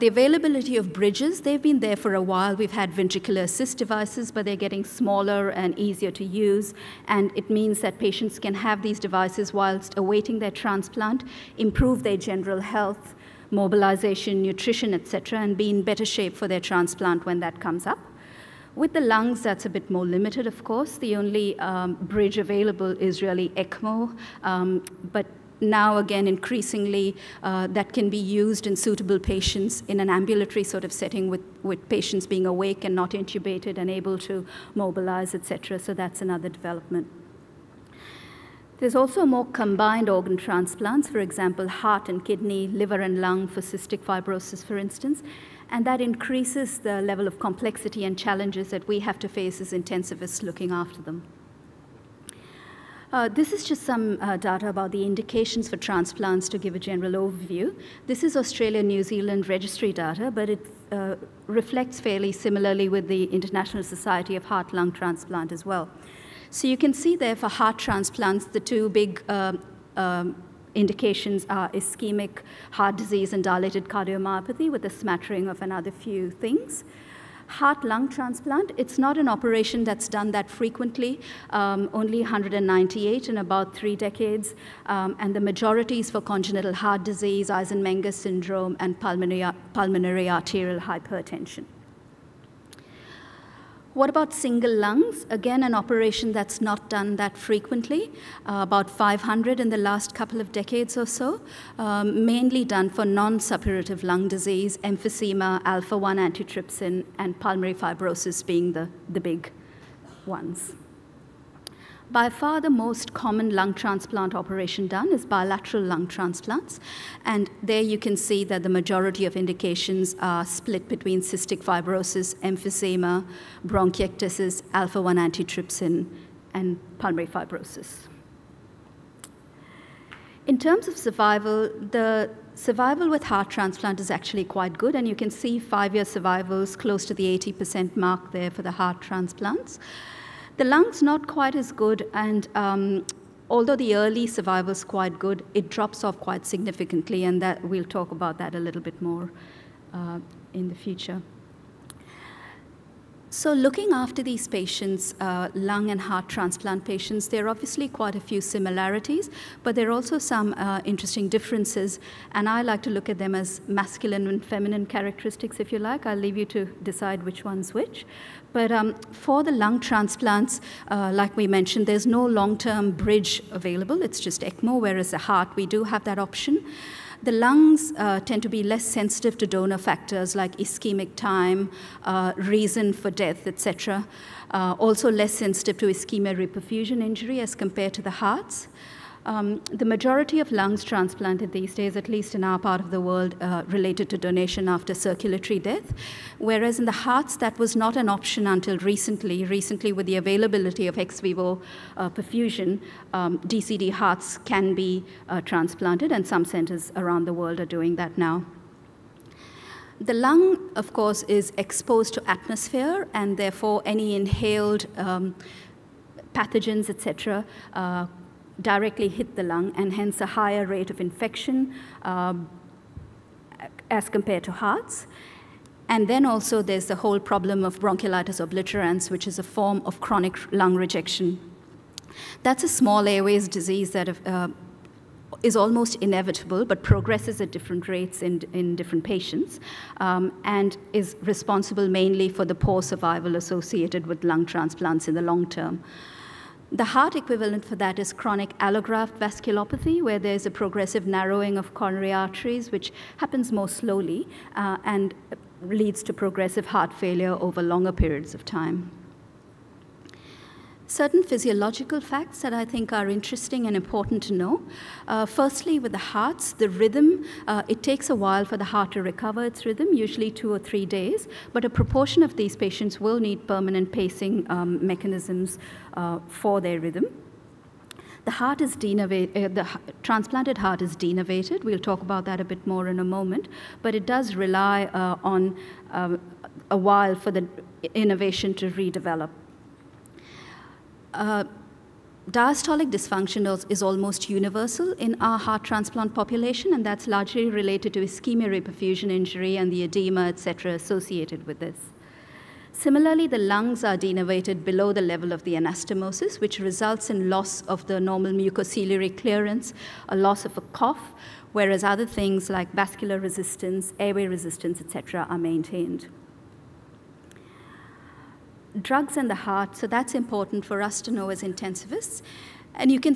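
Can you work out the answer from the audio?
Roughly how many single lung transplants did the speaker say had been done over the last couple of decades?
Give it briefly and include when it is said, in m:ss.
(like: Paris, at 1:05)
About 500, at 1:38.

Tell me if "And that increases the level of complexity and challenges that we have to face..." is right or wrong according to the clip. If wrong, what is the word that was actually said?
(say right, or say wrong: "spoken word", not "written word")
right.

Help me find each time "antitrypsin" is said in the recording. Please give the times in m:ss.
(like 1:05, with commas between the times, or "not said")
1:46, 2:05.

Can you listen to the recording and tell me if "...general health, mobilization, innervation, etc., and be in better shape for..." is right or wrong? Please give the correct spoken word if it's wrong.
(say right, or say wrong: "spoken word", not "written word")
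wrong: "nutrition", not "innervation".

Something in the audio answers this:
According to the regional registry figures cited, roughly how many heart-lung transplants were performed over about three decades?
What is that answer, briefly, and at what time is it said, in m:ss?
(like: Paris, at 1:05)
198, at 1:22.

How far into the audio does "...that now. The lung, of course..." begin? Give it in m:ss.
3:27.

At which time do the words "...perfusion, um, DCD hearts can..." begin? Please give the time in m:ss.
3:22.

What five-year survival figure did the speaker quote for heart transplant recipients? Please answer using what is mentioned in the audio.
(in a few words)
80%.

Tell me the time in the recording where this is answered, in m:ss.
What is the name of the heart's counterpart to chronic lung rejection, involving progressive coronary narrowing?
4:08.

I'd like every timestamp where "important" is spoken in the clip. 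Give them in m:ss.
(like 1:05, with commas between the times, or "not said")
4:23, 5:20.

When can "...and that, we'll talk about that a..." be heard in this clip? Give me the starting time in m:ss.
2:27.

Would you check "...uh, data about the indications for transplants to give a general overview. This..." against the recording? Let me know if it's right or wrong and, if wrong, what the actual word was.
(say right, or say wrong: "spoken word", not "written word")
right.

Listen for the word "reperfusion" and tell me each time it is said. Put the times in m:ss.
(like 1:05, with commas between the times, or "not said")
3:06, 4:58.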